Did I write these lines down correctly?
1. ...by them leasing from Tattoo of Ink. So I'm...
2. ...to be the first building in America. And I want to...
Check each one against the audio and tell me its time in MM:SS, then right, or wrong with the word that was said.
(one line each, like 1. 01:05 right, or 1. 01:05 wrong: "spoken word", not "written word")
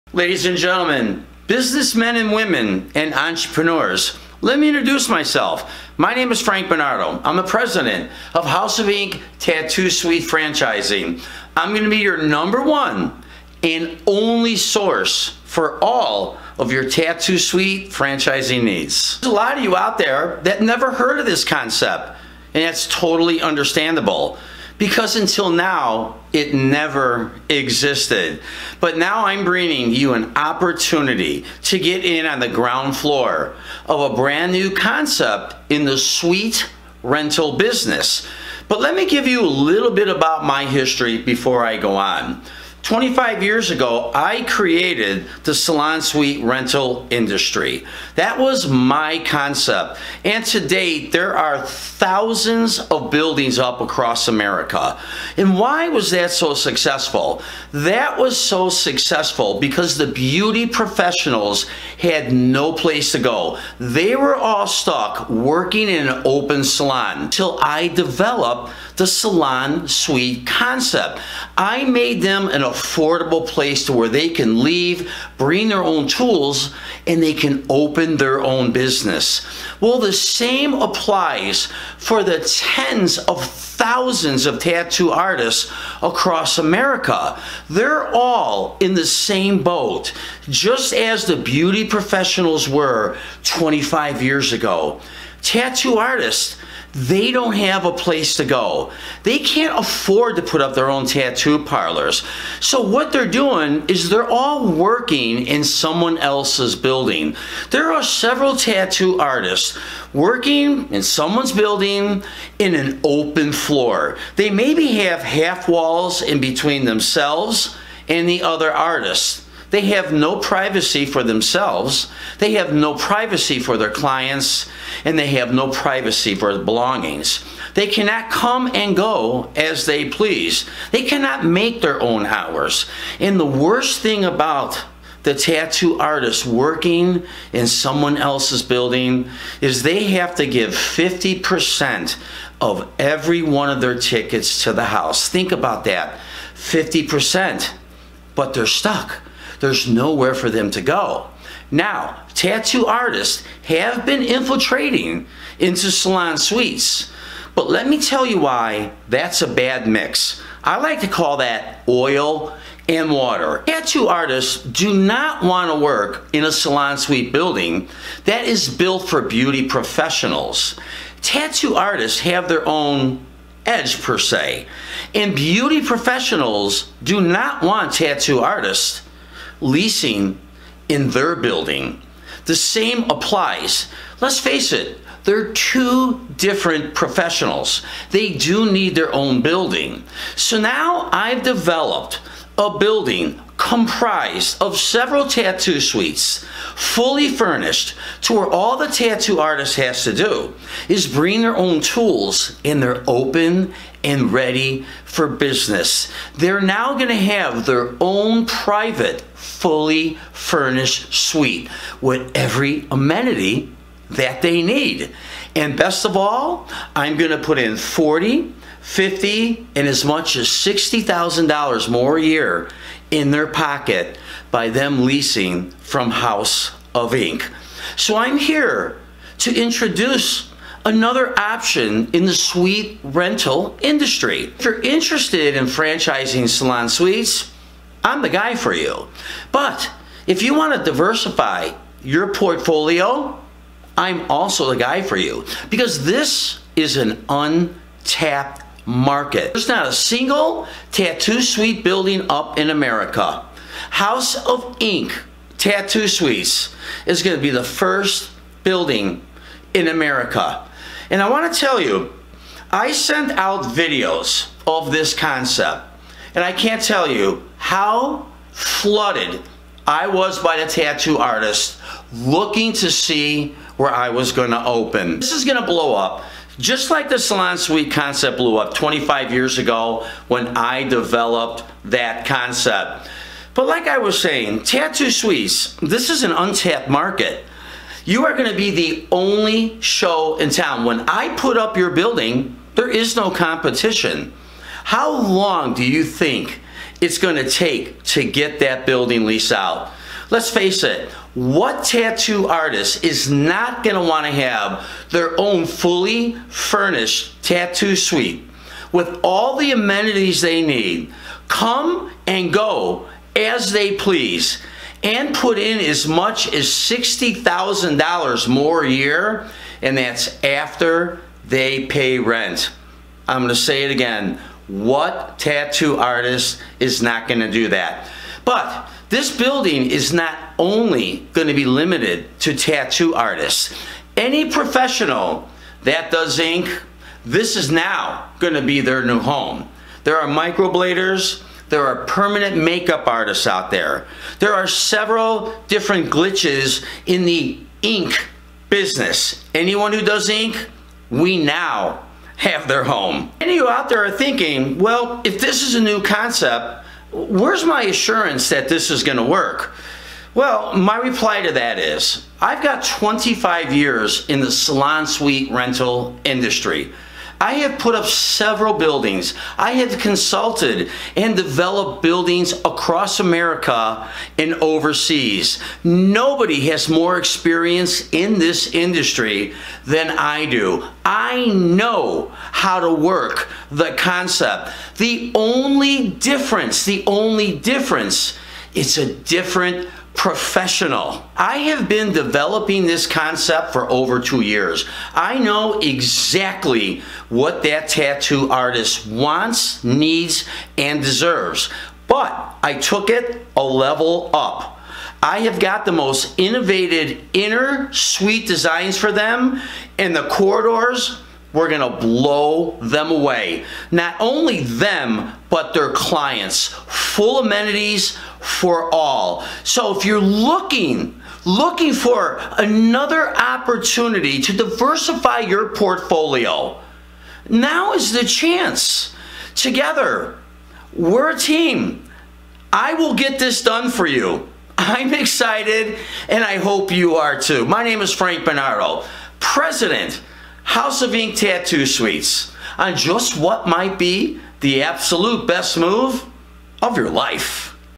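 1. 03:44 wrong: "House", not "Tattoo"
2. 04:17 right.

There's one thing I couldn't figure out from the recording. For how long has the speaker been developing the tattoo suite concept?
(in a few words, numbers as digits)
over two years.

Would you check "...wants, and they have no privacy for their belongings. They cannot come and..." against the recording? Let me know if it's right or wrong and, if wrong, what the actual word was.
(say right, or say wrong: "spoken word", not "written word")
wrong: "clients", not "wants".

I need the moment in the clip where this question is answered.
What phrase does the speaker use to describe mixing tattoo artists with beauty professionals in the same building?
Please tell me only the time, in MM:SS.
02:41.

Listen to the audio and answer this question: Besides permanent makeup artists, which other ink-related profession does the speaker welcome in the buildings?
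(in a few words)
microbladers.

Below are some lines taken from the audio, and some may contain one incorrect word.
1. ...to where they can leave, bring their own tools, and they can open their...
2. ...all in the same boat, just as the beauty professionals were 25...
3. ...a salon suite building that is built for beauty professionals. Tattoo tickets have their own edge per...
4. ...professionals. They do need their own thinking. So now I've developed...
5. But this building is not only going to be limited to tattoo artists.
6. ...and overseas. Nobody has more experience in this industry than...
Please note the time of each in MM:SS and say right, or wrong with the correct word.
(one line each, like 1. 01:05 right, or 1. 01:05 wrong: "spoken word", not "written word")
1. 01:13 right
2. 01:28 right
3. 02:46 wrong: "artists", not "tickets"
4. 03:06 wrong: "building", not "thinking"
5. 05:28 right
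6. 06:14 right.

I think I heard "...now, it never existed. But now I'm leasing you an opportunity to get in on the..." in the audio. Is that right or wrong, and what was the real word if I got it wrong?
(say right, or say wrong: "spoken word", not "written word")
wrong: "bringing", not "leasing".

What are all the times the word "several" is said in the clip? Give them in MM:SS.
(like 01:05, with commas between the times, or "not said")
01:48, 03:14, 05:44, 06:08.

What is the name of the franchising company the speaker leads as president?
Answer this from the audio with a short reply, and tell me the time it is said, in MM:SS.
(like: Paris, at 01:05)
House of Ink Tattoo Suite Franchising, at 00:08.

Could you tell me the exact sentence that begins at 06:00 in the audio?
Well, my reply to that is I've got 25 years in the salon suite rental industry.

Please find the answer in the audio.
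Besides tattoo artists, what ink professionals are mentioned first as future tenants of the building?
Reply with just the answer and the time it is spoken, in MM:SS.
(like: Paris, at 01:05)
microbladers, at 05:40.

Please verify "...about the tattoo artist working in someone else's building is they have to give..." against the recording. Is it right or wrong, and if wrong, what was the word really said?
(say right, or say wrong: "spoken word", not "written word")
right.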